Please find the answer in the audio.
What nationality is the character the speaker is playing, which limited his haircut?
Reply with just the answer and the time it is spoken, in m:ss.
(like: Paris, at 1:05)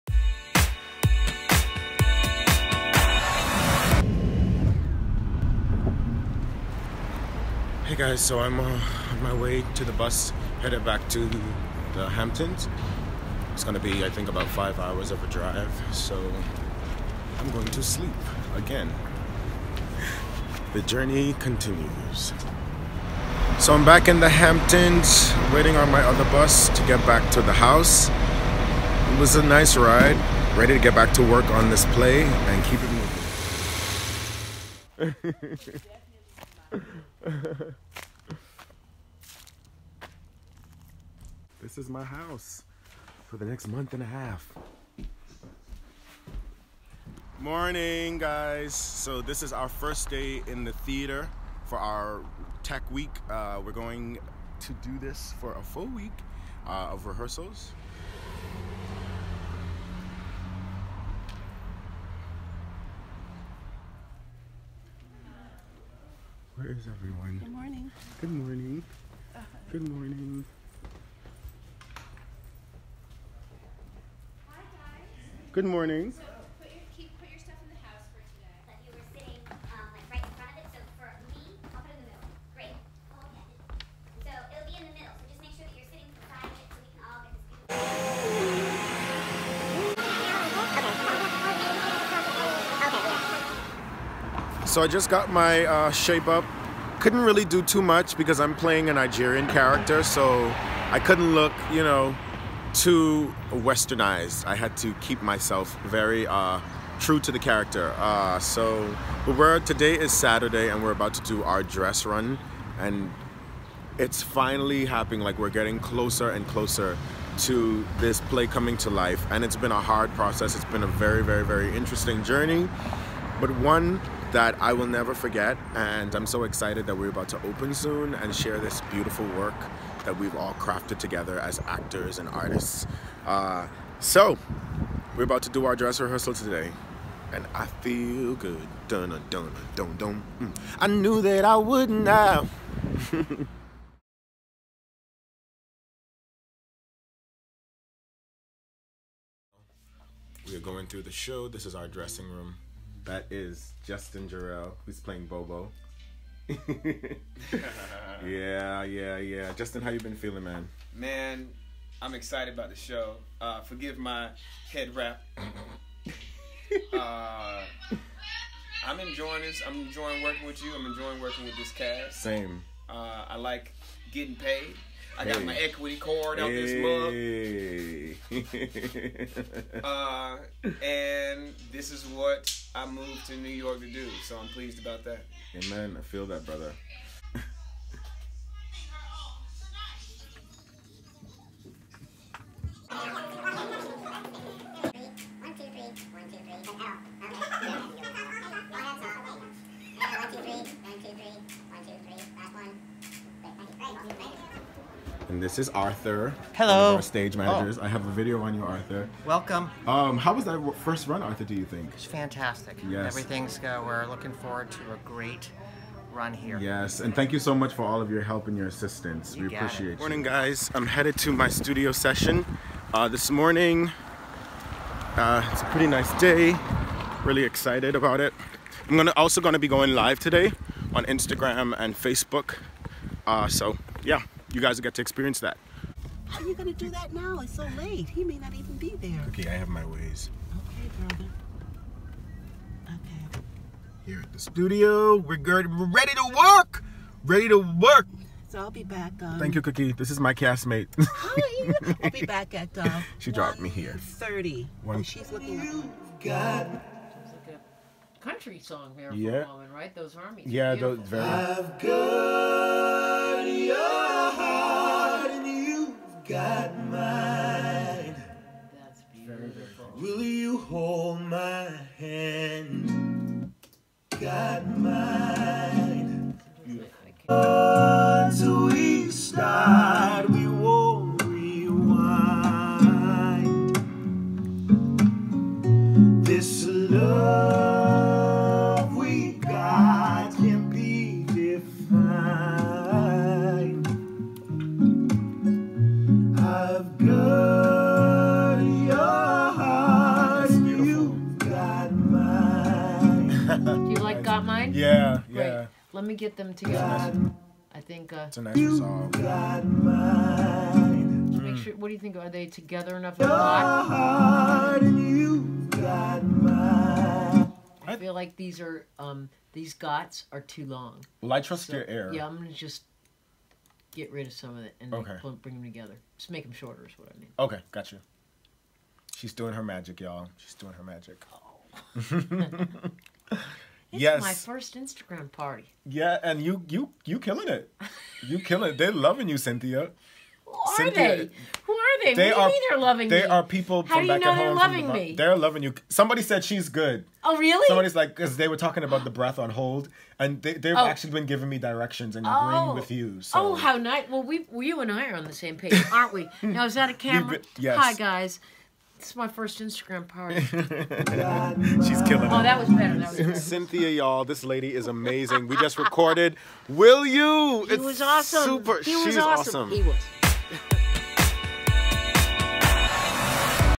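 Nigerian, at 1:38.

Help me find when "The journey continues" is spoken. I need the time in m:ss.
0:20.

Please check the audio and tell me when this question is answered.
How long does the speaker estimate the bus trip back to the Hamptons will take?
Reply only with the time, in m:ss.
0:14.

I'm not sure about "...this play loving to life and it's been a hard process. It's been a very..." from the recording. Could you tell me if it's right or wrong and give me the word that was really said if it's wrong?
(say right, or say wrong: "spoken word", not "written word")
wrong: "coming", not "loving".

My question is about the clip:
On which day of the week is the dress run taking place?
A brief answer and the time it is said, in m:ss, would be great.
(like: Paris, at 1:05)
Saturday, at 1:50.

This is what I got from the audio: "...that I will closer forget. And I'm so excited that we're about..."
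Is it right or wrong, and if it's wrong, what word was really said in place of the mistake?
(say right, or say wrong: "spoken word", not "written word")
wrong: "never", not "closer".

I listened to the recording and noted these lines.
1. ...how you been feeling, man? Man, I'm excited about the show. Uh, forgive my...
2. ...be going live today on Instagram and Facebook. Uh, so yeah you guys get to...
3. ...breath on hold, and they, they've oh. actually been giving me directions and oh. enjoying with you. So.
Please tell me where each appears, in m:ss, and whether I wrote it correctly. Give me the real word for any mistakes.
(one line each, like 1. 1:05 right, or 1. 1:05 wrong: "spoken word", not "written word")
1. 2:39 right
2. 3:49 right
3. 5:49 wrong: "agreeing", not "enjoying".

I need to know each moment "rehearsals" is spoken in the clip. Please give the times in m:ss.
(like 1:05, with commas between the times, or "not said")
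0:57, 2:16.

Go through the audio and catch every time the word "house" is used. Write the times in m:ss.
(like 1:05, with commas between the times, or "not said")
0:27, 0:42.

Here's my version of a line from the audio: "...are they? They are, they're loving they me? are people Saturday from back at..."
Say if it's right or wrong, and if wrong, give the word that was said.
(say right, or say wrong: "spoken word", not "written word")
wrong: "How", not "Saturday".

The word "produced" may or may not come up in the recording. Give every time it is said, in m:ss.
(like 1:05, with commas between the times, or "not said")
not said.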